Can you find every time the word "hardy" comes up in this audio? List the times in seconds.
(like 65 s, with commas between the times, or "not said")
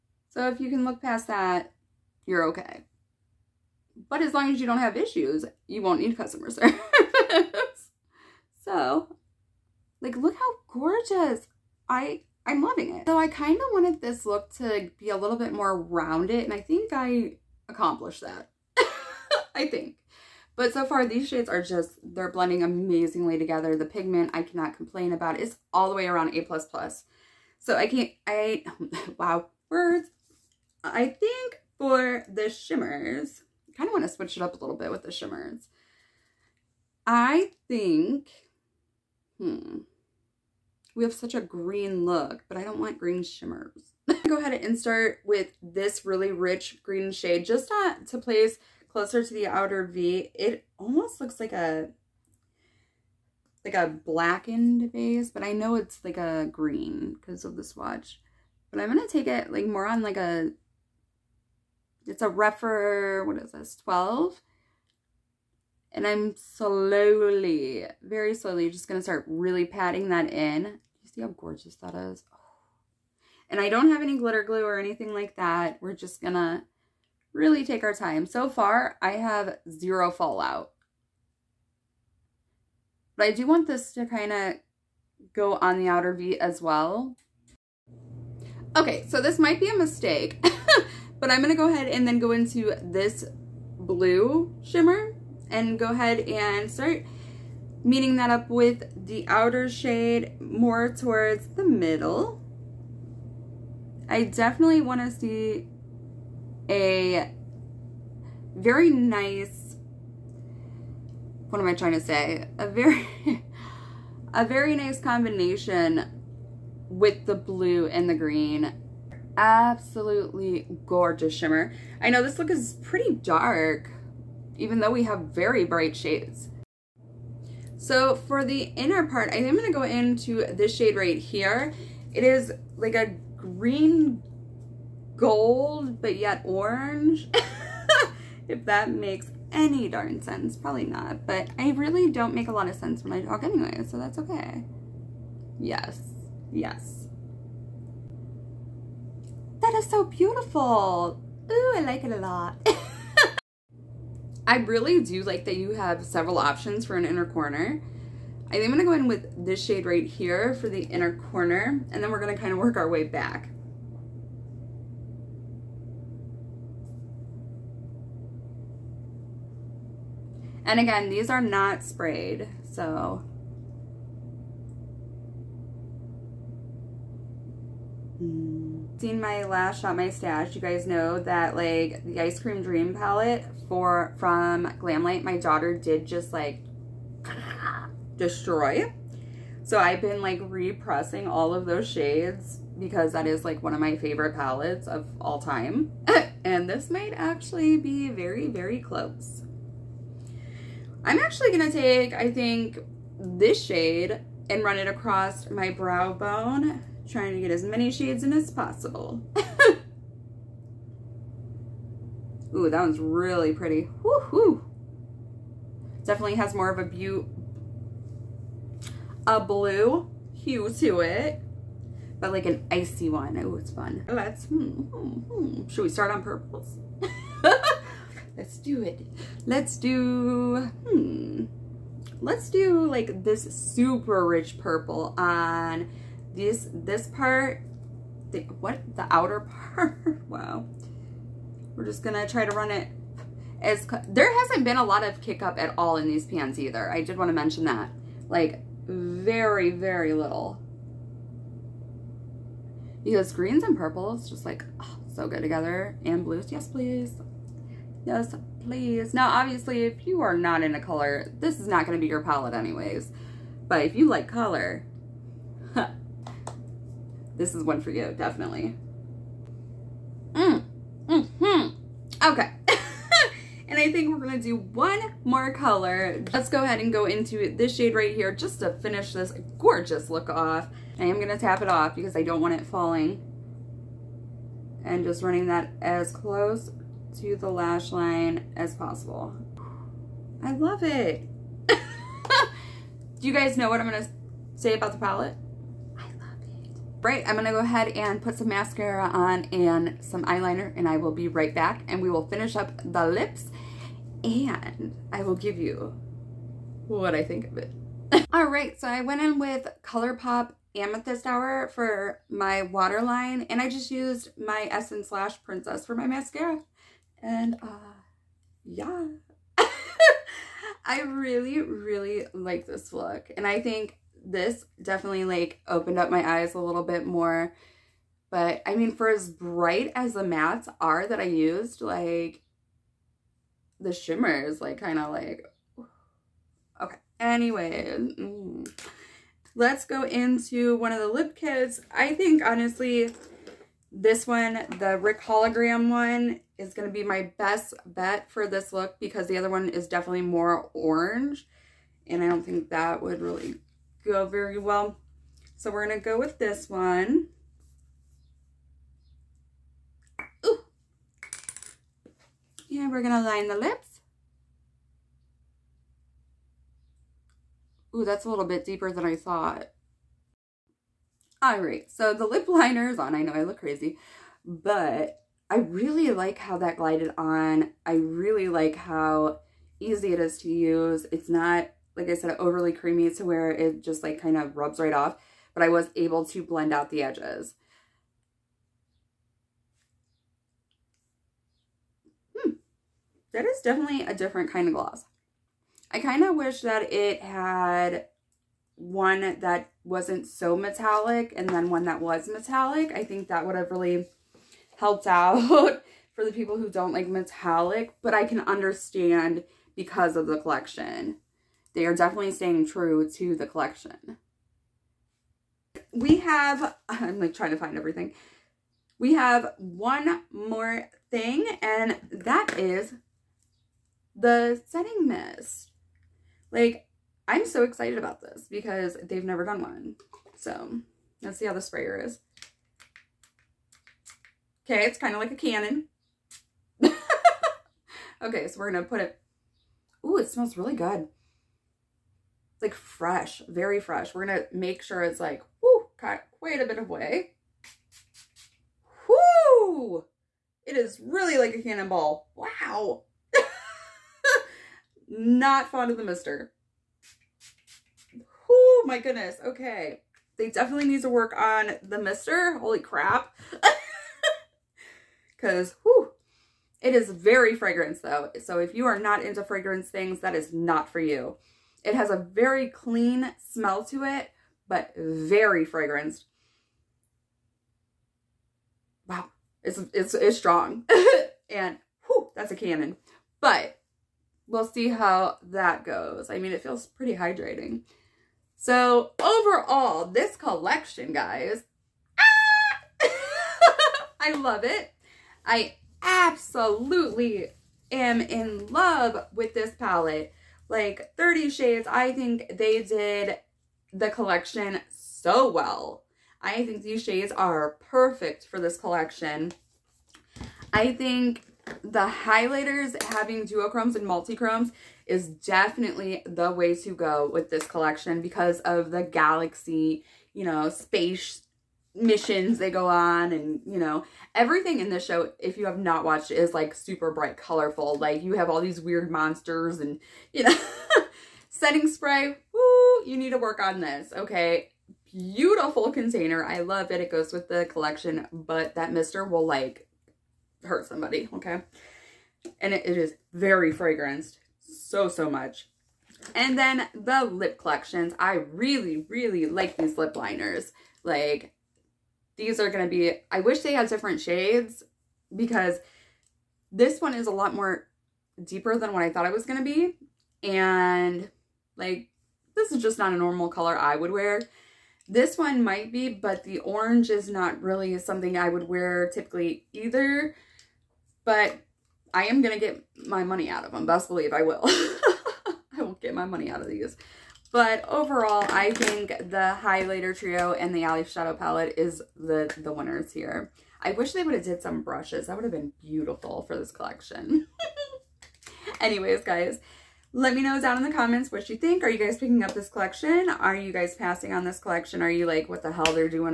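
not said.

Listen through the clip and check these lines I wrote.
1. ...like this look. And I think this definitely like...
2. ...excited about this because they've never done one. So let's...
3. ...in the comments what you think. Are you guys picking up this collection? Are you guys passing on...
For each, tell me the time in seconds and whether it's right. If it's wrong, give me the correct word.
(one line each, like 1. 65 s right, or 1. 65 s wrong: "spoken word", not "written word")
1. 322 s right
2. 427 s right
3. 590 s right.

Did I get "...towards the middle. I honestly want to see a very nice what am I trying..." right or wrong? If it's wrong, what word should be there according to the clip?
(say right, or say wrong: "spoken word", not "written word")
wrong: "definitely", not "honestly".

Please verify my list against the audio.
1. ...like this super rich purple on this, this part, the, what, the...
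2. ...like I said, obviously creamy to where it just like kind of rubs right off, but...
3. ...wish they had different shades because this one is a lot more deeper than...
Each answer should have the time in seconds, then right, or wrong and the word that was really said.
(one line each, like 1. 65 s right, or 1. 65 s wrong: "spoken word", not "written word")
1. 232 s right
2. 381 s wrong: "overly", not "obviously"
3. 553 s right.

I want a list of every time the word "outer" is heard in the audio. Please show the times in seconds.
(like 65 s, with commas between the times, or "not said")
49 s, 85 s, 99 s, 239 s.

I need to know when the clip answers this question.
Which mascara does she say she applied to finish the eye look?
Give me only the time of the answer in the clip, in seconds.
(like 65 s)
314 s.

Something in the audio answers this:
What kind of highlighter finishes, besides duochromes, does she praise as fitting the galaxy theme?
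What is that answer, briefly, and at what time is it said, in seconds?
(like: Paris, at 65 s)
Multi-chromes, at 514 s.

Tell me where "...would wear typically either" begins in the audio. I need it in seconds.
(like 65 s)
568 s.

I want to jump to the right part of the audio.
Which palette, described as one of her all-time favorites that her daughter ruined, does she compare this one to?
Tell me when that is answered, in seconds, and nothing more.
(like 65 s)
182 s.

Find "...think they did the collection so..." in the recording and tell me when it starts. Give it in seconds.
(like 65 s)
502 s.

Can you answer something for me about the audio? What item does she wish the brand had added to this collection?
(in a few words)
Brushes.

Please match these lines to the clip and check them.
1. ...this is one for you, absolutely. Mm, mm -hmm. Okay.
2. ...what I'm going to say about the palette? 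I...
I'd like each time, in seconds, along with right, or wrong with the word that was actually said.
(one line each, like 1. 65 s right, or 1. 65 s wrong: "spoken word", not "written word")
1. 267 s wrong: "definitely", not "absolutely"
2. 293 s right.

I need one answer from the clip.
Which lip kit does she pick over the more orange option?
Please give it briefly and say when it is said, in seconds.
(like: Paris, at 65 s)
Rick hologram, at 344 s.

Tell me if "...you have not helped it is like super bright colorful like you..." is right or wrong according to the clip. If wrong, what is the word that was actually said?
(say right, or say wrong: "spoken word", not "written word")
wrong: "watched", not "helped".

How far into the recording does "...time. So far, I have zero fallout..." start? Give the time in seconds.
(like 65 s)
77 s.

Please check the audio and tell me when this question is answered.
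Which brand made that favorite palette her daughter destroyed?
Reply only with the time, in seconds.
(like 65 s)
184 s.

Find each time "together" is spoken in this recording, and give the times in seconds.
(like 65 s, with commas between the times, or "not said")
23 s, 255 s.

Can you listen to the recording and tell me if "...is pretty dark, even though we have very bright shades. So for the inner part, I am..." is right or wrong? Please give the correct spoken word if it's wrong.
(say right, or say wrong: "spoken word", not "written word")
right.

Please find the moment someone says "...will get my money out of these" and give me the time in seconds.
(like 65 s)
575 s.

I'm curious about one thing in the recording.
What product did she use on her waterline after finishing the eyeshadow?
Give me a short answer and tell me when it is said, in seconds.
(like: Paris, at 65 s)
ColourPop Amethyst Hour, at 309 s.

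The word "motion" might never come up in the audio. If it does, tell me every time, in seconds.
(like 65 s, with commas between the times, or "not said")
not said.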